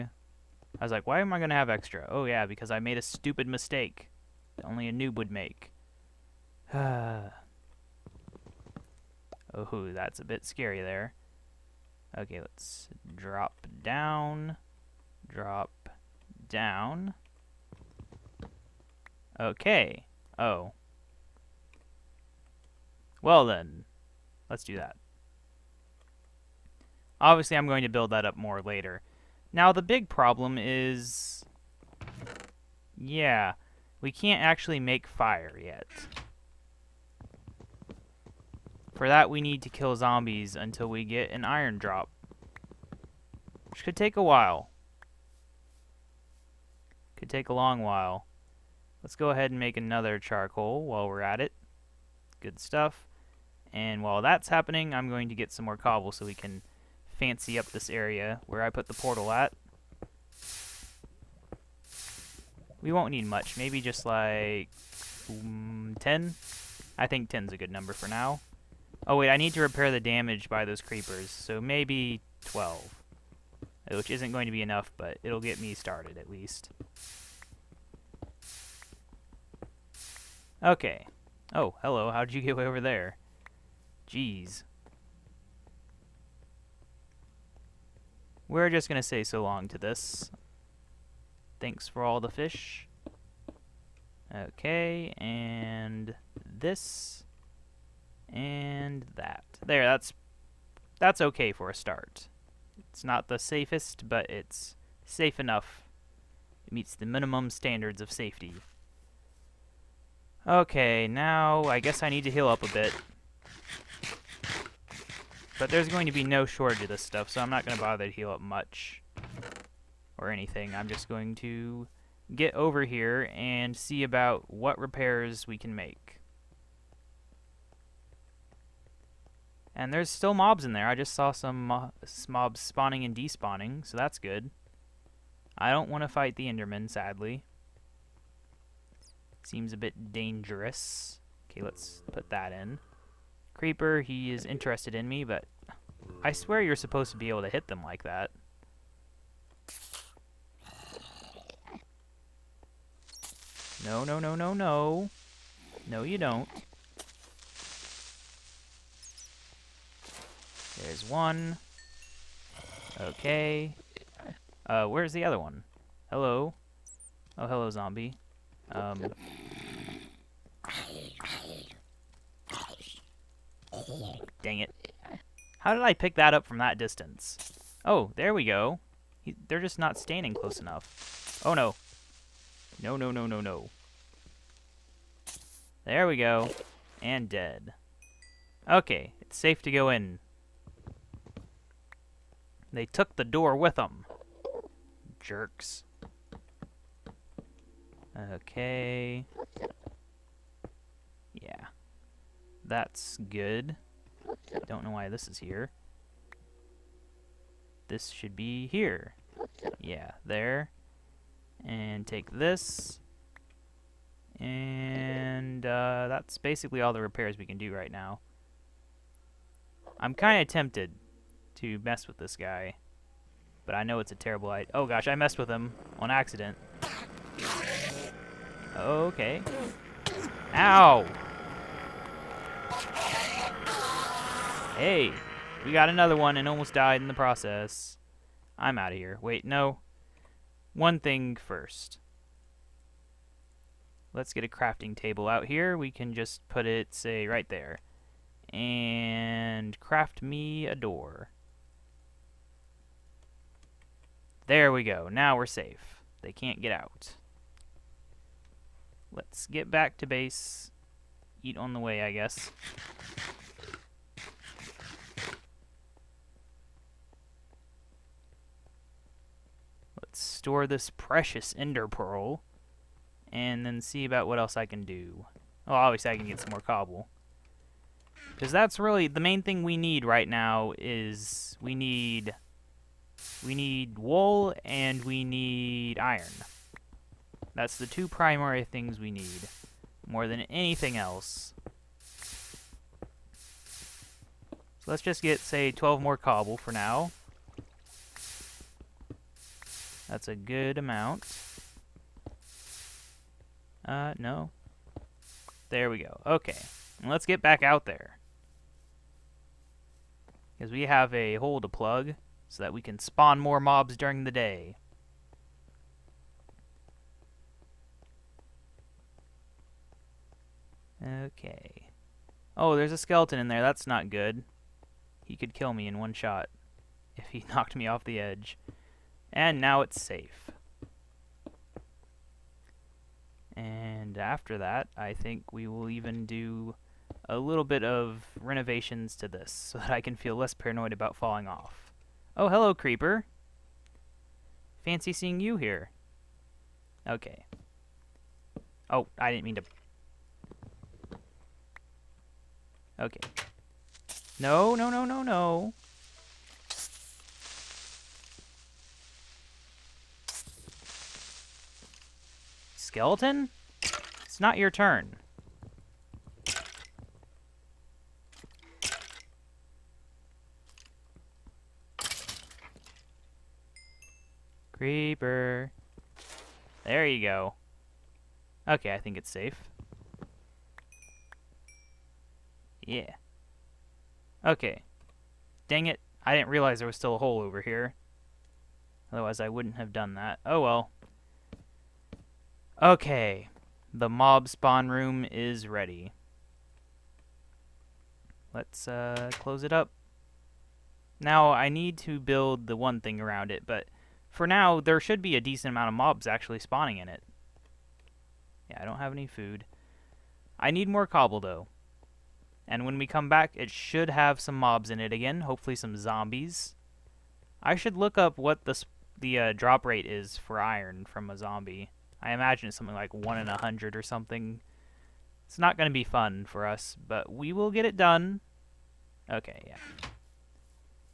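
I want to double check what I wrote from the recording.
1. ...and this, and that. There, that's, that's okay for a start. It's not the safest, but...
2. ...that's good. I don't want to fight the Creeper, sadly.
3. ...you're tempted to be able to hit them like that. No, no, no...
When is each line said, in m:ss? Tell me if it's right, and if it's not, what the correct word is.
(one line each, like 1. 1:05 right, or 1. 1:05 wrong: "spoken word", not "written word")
1. 1:35 right
2. 2:13 wrong: "Enderman", not "Creeper"
3. 2:26 wrong: "supposed", not "tempted".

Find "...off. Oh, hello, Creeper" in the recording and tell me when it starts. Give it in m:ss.
5:41.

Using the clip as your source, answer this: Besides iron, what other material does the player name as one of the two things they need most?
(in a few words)
wool.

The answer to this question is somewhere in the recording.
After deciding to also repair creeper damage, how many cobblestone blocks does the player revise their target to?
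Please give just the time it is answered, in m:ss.
1:11.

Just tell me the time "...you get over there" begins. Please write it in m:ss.
1:22.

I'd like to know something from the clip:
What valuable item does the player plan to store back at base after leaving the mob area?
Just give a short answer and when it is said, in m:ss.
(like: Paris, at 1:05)
ender pearl, at 4:31.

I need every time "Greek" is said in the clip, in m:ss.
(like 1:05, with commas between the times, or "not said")
not said.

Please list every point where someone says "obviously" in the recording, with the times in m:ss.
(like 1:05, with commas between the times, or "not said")
0:27, 4:35.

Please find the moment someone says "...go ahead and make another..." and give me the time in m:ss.
0:49.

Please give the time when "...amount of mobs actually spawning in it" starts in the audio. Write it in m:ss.
6:45.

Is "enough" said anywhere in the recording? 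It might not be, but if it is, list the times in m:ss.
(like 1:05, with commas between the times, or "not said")
1:14, 1:45, 3:00.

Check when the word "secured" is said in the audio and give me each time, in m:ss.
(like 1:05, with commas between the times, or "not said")
not said.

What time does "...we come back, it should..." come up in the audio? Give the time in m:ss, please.
6:52.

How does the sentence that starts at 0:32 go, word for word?
Yeah, we can't actually make fire yet.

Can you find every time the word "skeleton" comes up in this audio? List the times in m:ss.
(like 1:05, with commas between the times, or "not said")
5:22, 6:02.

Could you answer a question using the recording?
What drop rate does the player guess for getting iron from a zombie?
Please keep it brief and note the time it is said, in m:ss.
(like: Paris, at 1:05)
1 in 100, at 7:03.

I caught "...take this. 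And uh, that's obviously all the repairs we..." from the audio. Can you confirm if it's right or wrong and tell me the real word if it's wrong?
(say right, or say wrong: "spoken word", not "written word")
wrong: "basically", not "obviously".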